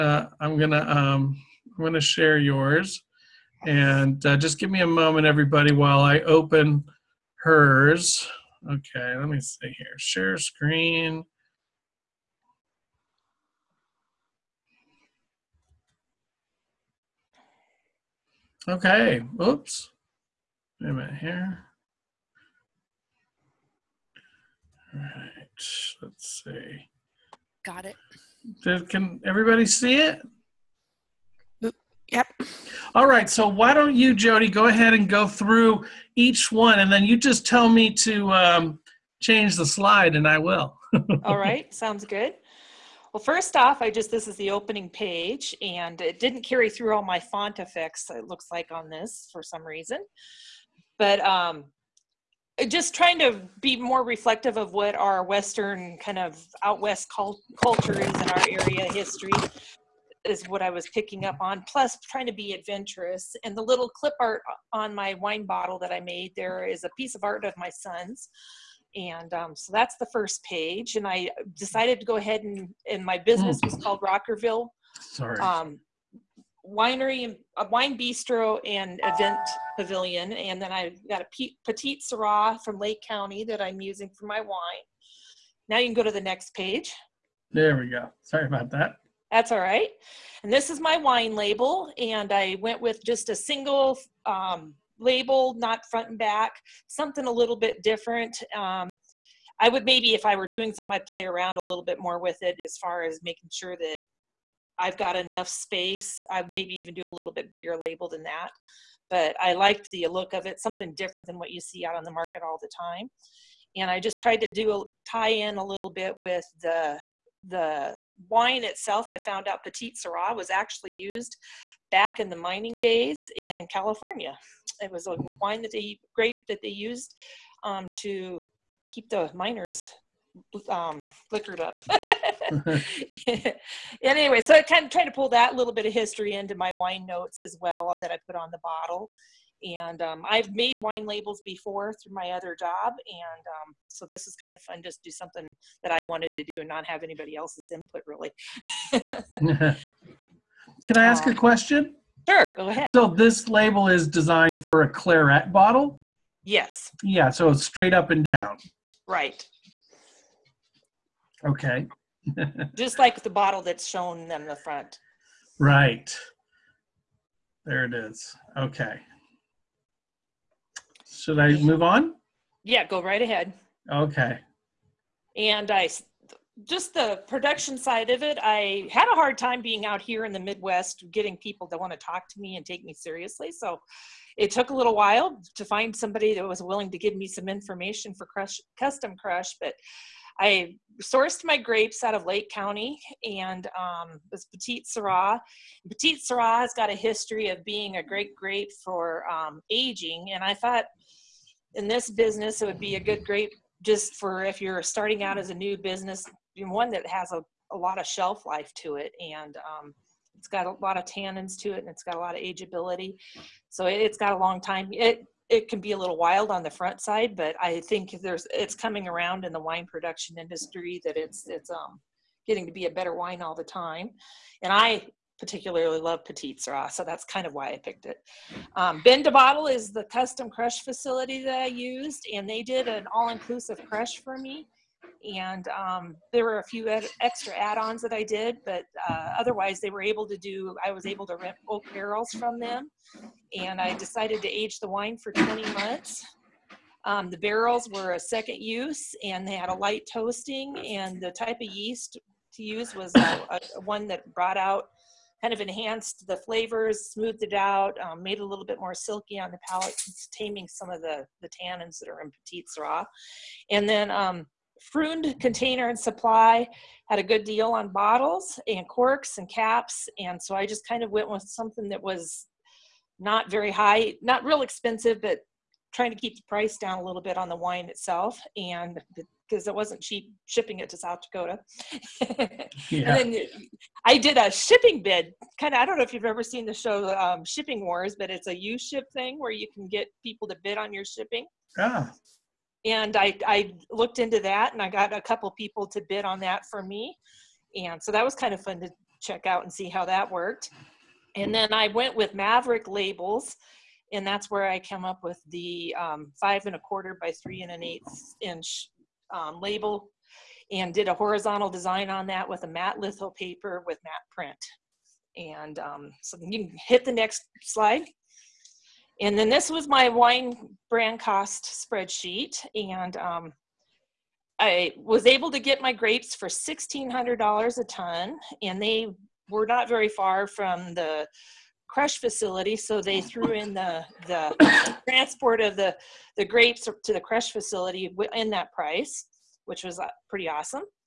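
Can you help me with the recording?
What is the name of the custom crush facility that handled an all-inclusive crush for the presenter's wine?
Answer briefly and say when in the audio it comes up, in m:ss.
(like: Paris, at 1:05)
Ben Bottle, at 3:49.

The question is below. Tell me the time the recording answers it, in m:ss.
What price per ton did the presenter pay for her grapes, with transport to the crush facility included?
5:26.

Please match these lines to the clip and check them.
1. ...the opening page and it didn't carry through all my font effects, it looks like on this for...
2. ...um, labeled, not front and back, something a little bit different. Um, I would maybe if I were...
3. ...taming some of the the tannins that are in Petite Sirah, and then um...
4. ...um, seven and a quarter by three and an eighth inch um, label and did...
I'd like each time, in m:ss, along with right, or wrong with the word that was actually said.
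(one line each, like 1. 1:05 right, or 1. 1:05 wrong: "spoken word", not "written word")
1. 0:44 right
2. 1:34 right
3. 4:20 right
4. 5:05 wrong: "five", not "seven".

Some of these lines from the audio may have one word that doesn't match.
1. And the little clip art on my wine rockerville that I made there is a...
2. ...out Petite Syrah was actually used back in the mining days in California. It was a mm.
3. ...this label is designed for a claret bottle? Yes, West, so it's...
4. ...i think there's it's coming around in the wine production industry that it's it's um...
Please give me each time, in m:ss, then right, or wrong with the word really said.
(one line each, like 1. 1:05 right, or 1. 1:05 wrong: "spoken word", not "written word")
1. 1:03 wrong: "bottle", not "rockerville"
2. 1:59 right
3. 2:33 wrong: "Yeah", not "West"
4. 3:37 right.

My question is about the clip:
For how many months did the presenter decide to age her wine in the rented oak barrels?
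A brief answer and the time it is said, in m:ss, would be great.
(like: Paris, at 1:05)
20 months, at 4:05.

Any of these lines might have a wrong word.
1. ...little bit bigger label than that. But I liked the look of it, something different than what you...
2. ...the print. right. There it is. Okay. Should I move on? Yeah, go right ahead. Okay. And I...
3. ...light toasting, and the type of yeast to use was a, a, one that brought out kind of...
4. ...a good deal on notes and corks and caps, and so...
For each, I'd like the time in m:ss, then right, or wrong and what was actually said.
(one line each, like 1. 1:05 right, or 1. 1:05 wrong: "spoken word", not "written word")
1. 1:47 right
2. 2:44 wrong: "front", not "print"
3. 4:09 right
4. 4:27 wrong: "bottles", not "notes".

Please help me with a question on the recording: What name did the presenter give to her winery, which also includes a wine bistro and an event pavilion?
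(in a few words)
Rockerville.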